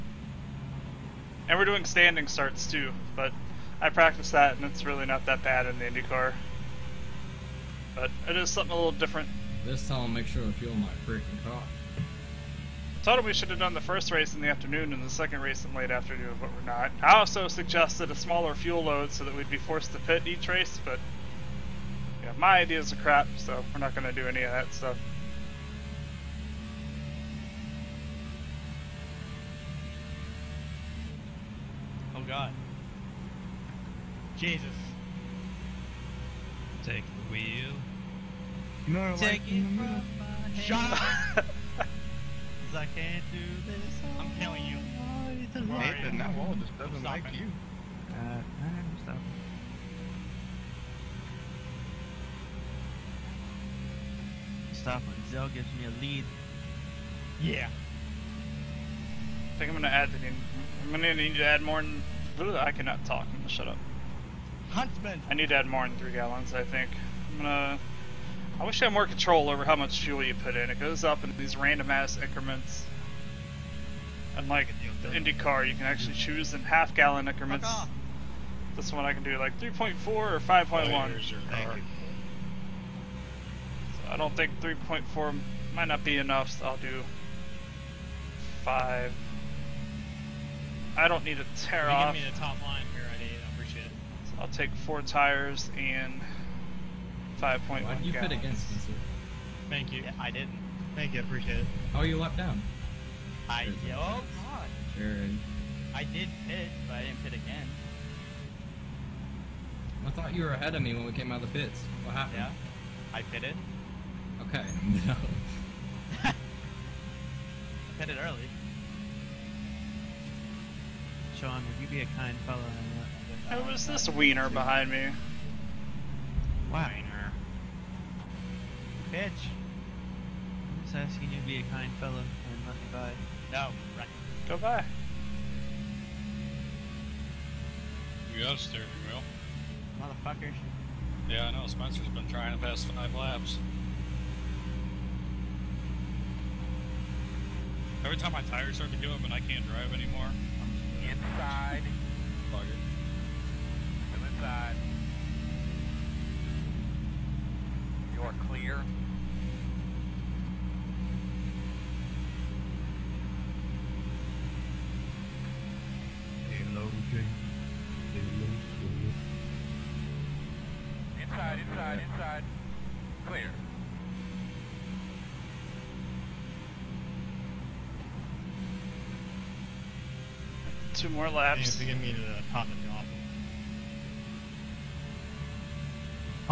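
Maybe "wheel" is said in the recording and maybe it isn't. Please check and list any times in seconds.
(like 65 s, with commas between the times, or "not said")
37 s, 139 s.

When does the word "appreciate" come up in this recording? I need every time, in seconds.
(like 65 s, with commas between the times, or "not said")
93 s, 101 s.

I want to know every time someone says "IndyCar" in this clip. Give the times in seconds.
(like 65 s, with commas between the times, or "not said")
5 s, 75 s.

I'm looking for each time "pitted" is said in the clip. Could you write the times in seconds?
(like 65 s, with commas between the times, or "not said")
113 s, 117 s.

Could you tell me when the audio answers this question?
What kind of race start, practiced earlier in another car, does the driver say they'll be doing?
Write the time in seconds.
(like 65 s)
1 s.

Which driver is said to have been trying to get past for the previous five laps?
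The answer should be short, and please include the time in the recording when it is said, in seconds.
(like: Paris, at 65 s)
Spencer, at 141 s.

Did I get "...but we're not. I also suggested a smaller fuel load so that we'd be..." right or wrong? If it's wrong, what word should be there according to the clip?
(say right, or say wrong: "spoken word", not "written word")
right.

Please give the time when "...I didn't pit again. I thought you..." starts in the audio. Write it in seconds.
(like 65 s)
106 s.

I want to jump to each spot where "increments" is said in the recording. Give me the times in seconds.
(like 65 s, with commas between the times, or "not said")
72 s, 77 s.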